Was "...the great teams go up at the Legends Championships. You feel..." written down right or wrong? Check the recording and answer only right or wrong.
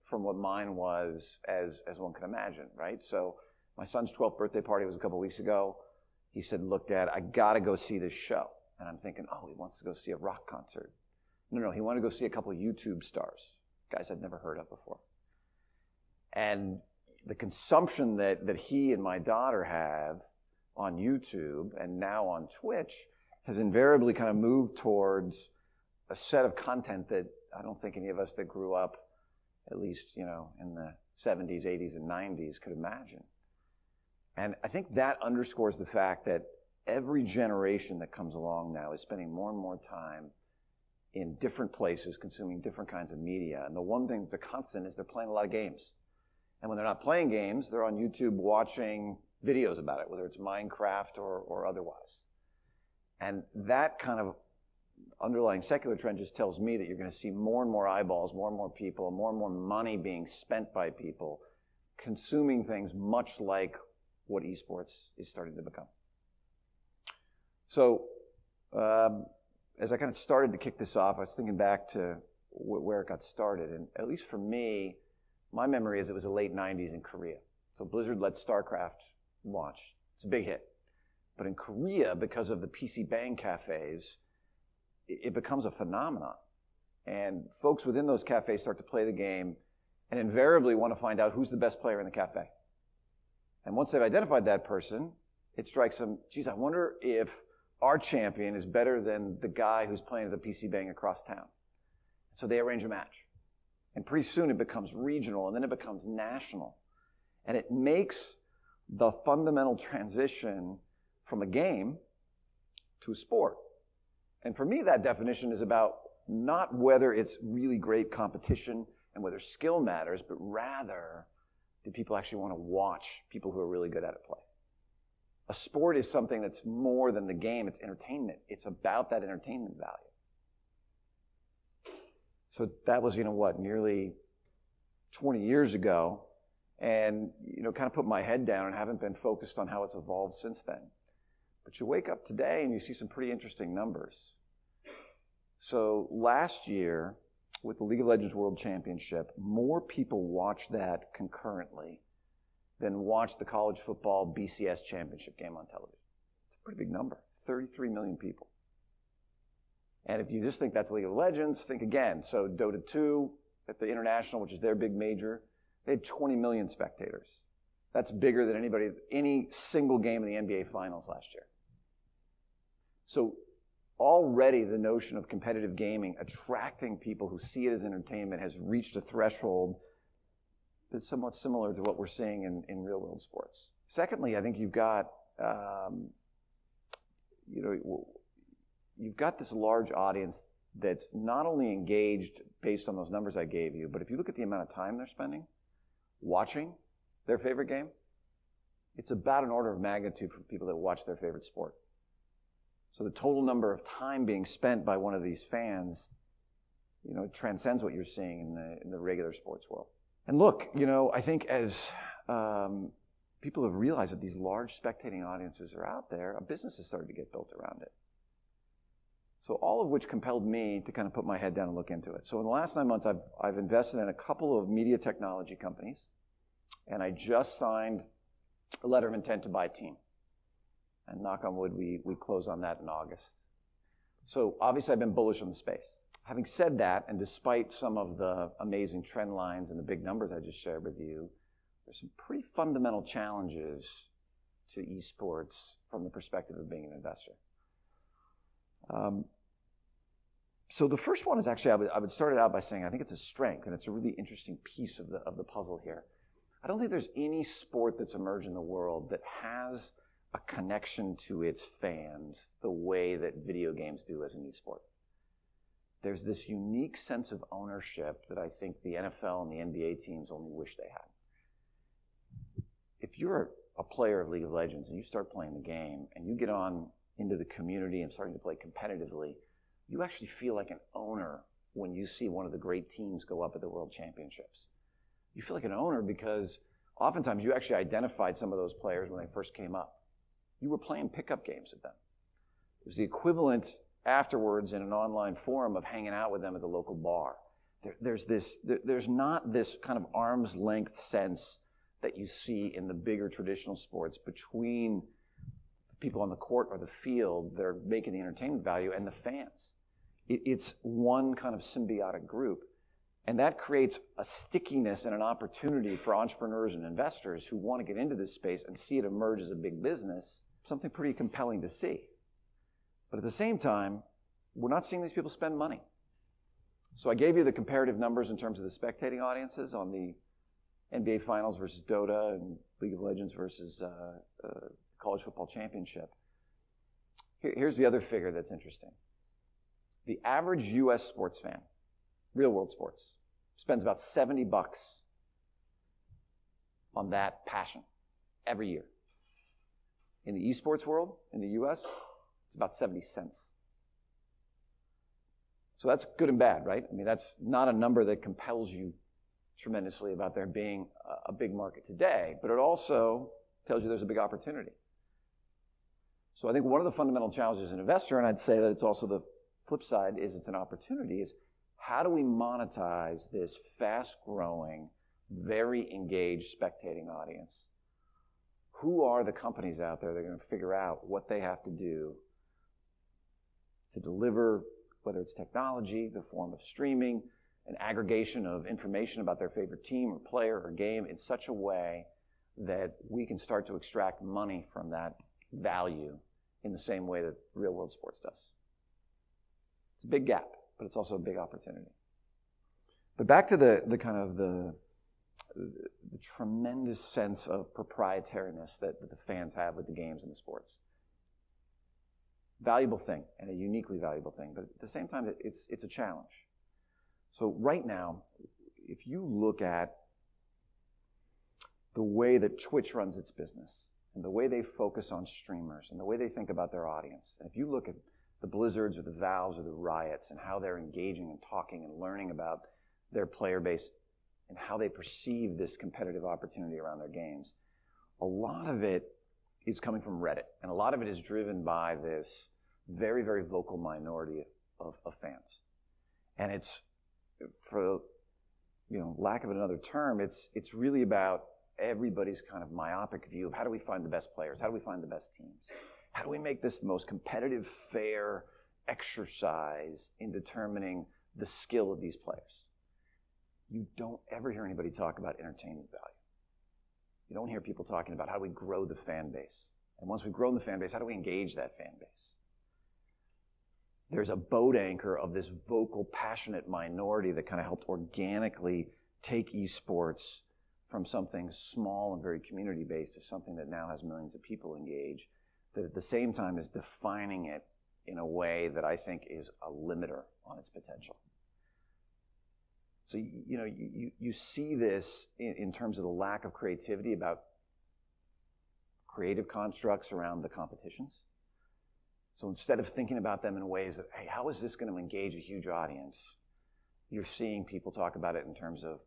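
wrong.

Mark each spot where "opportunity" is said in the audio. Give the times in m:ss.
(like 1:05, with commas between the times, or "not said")
5:15, 6:04, 6:10, 6:41, 7:16.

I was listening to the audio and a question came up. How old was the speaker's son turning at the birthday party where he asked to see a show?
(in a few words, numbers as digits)
12.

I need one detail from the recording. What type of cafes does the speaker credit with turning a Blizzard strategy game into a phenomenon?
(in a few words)
PC Bang cafes.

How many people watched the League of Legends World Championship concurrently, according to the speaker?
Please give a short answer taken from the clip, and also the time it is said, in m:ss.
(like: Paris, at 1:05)
33 million, at 2:37.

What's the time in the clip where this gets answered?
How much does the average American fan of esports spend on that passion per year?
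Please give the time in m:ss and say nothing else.
5:52.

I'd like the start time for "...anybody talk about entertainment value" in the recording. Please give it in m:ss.
7:44.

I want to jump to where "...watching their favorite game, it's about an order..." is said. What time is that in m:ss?
3:16.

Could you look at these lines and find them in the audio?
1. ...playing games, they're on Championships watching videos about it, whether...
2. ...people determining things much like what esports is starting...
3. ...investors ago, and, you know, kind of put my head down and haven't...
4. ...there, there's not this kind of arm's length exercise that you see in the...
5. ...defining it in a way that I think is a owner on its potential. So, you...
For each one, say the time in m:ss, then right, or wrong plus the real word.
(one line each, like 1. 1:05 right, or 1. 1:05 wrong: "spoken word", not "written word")
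1. 0:47 wrong: "YouTube", not "Championships"
2. 1:00 wrong: "consuming", not "determining"
3. 2:15 wrong: "years", not "investors"
4. 4:58 wrong: "sense", not "exercise"
5. 8:06 wrong: "limiter", not "owner".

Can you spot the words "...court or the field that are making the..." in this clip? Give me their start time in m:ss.
5:06.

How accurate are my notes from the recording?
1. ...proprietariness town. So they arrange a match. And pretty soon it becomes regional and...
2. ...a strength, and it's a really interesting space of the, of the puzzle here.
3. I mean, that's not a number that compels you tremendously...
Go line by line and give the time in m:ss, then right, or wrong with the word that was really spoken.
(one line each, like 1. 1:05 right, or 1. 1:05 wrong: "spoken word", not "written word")
1. 1:40 wrong: "across", not "proprietariness"
2. 4:13 wrong: "piece", not "space"
3. 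5:56 right.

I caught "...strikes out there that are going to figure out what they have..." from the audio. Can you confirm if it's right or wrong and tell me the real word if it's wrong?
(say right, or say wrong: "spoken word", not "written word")
wrong: "companies", not "strikes".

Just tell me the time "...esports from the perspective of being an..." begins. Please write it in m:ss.
4:04.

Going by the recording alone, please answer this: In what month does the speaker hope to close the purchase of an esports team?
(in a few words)
August.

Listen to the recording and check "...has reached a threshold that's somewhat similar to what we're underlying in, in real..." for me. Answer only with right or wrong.
wrong.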